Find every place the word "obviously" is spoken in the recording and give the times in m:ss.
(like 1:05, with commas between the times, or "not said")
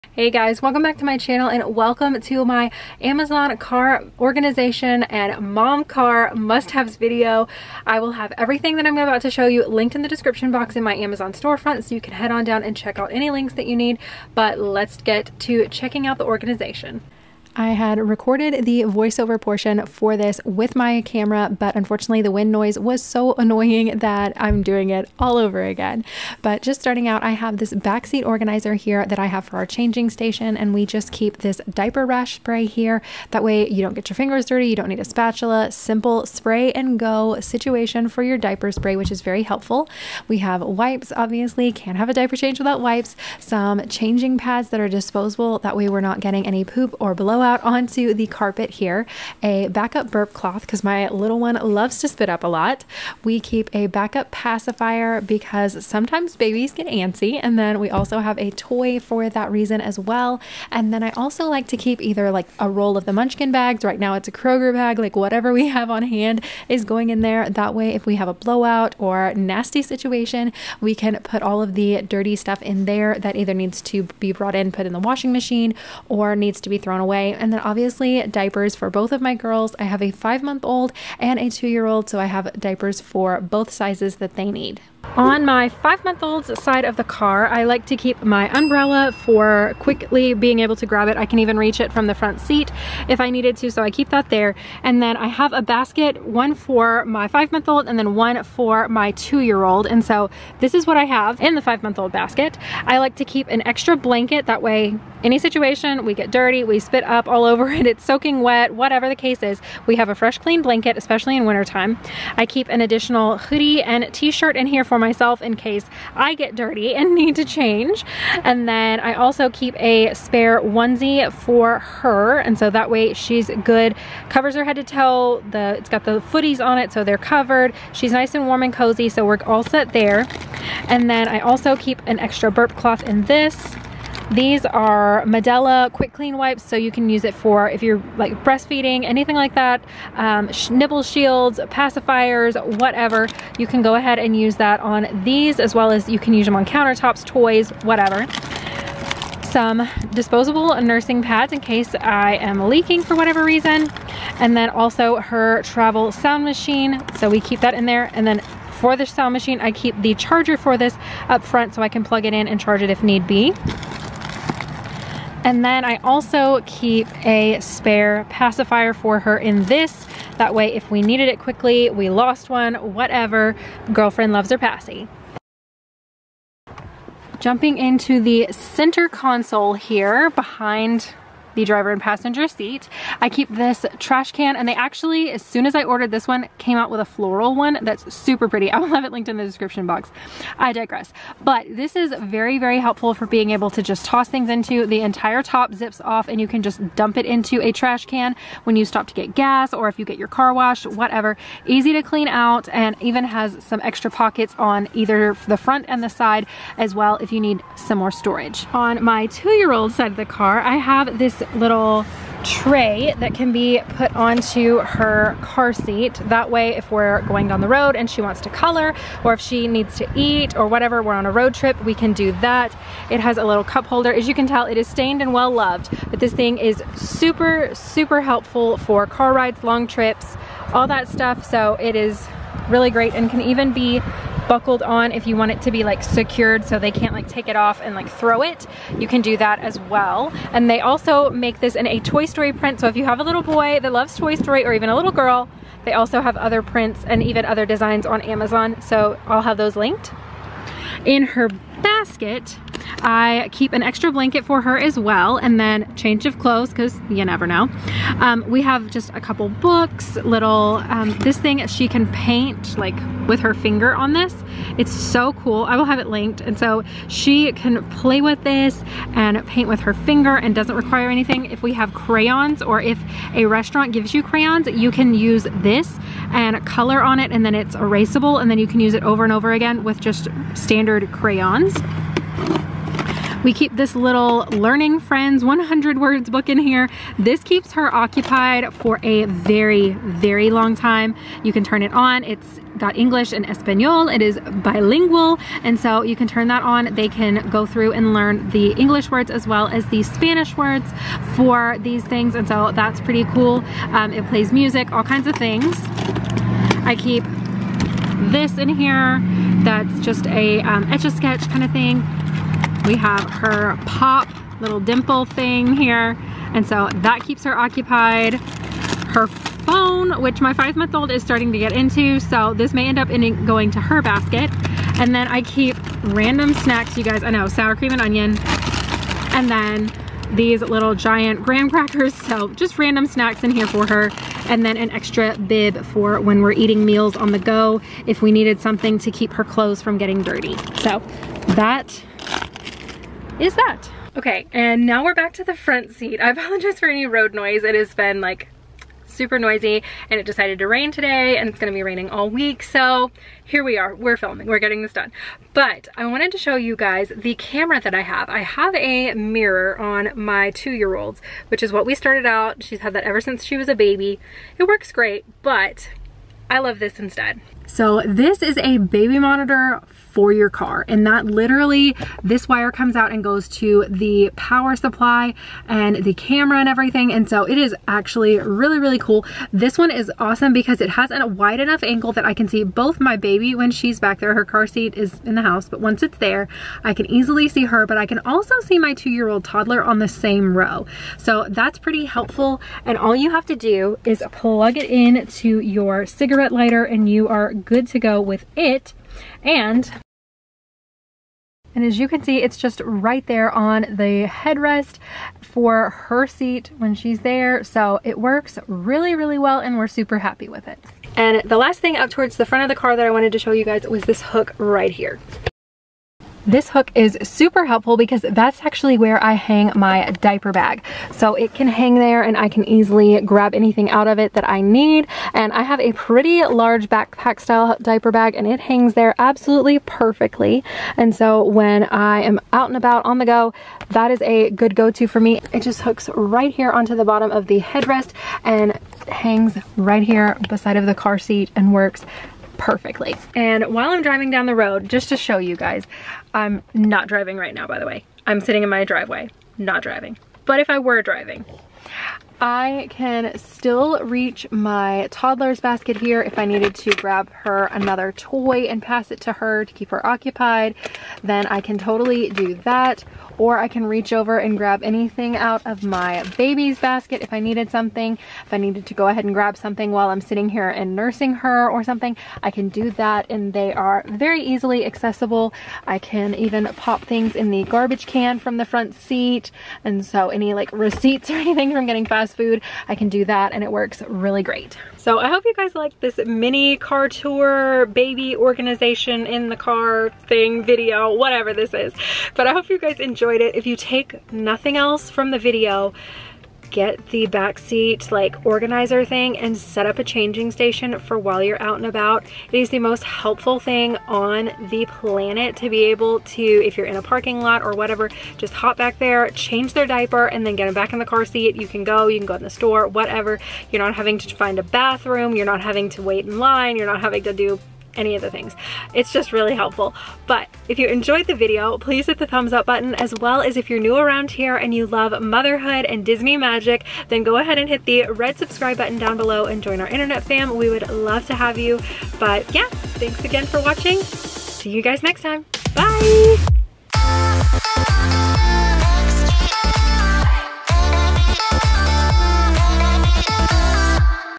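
0:41, 1:17.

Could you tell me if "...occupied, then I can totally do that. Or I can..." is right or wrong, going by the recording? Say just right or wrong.
right.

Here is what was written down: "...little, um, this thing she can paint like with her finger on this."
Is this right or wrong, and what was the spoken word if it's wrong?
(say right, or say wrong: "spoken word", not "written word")
right.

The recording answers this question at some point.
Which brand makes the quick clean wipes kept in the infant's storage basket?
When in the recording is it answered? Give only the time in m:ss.
2:15.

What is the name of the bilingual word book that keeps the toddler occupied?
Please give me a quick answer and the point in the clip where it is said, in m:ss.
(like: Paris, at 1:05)
Learning Friends 100 words, at 4:44.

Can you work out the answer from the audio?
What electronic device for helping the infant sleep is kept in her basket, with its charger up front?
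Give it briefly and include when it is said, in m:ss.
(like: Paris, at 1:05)
travel sound machine, at 2:35.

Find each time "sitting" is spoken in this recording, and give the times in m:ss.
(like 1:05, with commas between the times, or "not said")
7:28, 7:50.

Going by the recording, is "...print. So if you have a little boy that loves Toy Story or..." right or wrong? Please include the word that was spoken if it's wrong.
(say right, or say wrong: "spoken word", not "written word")
right.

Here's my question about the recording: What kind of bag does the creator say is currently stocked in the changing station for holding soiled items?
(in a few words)
Kroger bag.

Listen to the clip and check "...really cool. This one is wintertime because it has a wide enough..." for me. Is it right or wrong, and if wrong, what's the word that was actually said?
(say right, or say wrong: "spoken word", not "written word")
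wrong: "awesome", not "wintertime".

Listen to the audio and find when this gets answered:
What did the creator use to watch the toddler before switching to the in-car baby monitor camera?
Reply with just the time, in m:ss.
5:59.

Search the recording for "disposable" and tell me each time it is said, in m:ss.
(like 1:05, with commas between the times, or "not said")
0:44, 2:30.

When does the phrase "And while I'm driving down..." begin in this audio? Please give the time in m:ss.
7:23.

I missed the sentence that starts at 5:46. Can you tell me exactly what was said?
I apologize for any road noise.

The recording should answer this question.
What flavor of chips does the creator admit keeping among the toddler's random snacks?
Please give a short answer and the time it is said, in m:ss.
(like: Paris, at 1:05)
sour cream and onion, at 5:27.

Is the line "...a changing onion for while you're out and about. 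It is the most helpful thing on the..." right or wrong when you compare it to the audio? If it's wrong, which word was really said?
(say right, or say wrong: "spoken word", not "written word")
wrong: "station", not "onion".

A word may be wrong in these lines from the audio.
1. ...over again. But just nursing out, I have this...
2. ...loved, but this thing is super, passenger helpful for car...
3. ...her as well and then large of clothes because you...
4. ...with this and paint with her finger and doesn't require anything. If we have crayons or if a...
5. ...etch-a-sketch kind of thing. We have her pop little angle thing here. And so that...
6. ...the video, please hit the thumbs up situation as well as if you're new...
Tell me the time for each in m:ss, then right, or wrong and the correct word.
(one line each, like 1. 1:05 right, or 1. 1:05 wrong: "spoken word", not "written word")
1. 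0:25 wrong: "starting", not "nursing"
2. 3:45 wrong: "super", not "passenger"
3. 4:14 wrong: "change", not "large"
4. 4:28 right
5. 5:10 wrong: "dimple", not "angle"
6. 8:41 wrong: "button", not "situation".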